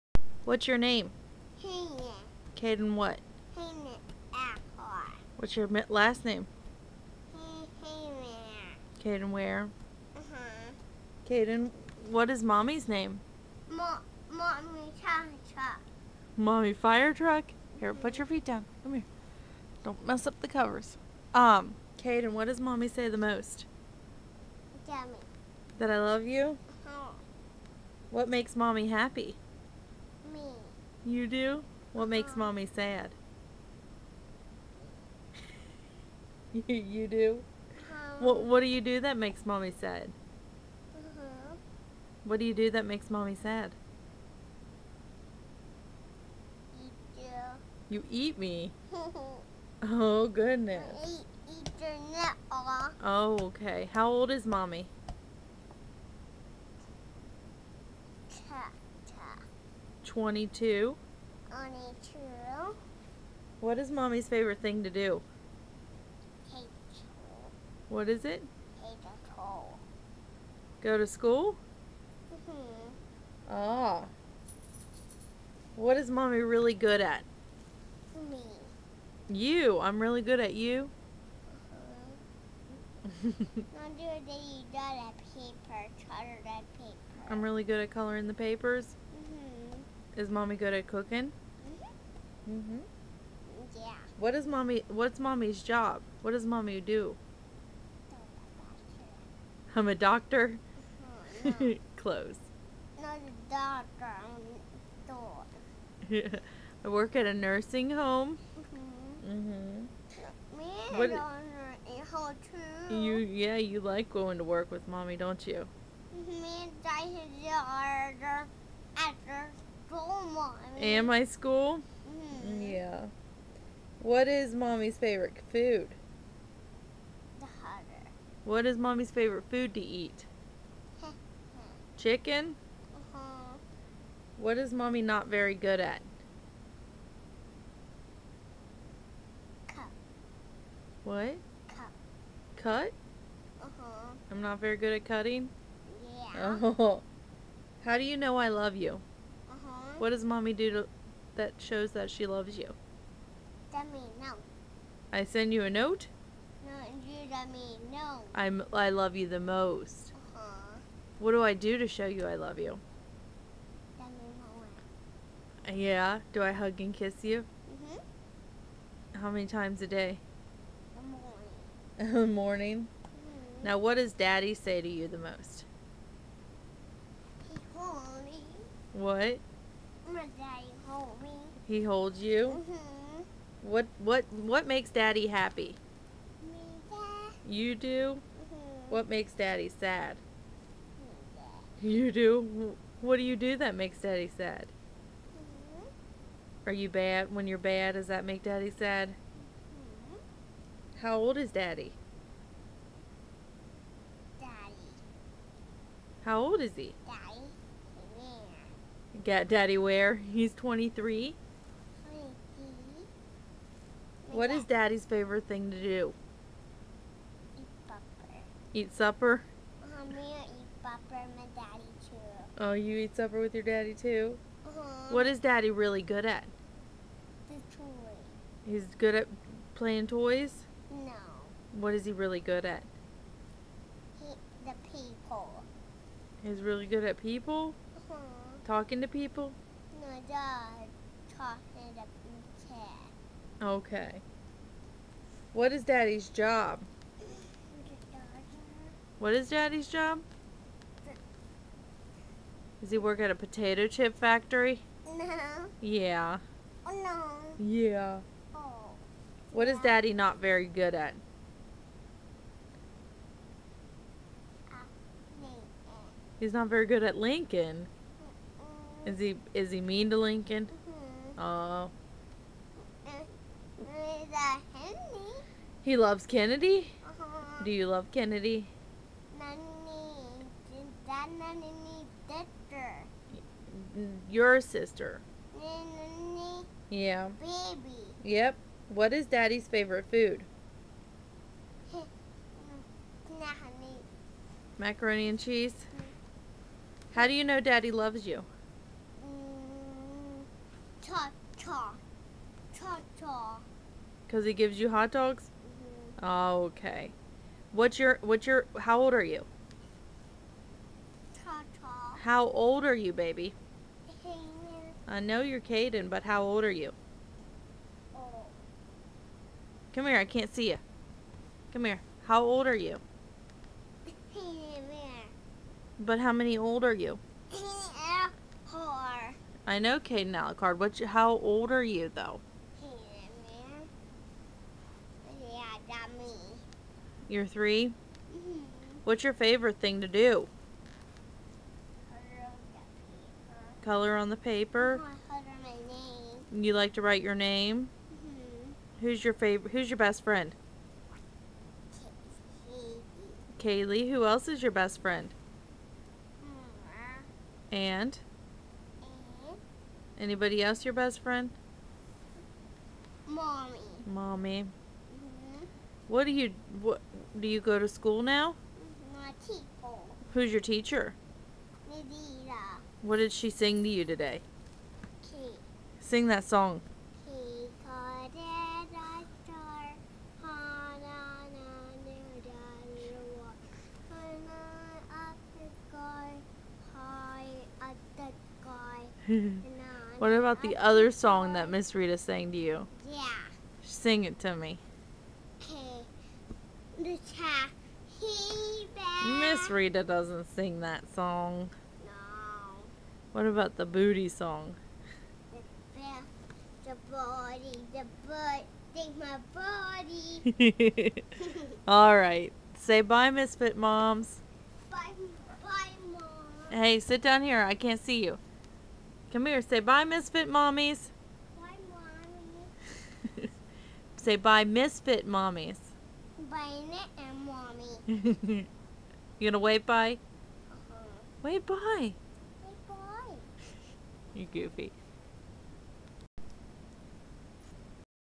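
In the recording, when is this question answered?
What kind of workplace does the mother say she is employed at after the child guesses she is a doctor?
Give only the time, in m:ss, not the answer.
1:46.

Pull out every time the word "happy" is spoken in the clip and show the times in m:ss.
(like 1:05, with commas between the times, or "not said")
0:28, 3:05.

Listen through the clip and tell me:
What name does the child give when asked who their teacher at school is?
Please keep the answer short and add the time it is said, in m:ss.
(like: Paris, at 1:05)
Nadira, at 6:11.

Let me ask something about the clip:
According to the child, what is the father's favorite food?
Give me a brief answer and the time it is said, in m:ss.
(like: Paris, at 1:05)
Macaroni and cheese, at 4:54.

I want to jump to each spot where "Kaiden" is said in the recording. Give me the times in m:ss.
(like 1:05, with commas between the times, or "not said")
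0:02, 0:11, 0:21, 5:15, 5:30.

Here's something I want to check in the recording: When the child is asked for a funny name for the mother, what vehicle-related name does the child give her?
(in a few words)
Mommy fire truck.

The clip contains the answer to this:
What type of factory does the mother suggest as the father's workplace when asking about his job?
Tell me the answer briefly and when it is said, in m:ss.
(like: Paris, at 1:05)
Potato chip factory, at 4:13.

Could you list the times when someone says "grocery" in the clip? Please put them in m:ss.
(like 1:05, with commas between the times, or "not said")
not said.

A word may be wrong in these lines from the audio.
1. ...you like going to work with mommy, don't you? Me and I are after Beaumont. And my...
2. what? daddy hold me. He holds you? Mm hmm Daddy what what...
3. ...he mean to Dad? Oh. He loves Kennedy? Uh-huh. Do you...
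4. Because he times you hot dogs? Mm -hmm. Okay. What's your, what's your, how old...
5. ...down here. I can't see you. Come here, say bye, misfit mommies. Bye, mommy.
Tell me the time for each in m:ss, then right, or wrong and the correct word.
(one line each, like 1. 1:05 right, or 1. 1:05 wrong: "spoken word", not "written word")
1. 1:53 right
2. 2:58 wrong: "What", not "Daddy"
3. 4:29 wrong: "Lincoln", not "Dad"
4. 5:04 wrong: "gives", not "times"
5. 6:57 right.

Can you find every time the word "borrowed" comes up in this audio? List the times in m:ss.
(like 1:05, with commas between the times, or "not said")
not said.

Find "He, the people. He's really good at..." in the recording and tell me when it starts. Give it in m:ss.
3:54.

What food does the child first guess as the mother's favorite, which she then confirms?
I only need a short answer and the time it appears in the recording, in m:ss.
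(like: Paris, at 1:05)
Chicken, at 2:11.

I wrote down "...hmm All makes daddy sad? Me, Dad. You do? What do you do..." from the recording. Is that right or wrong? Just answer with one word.
wrong.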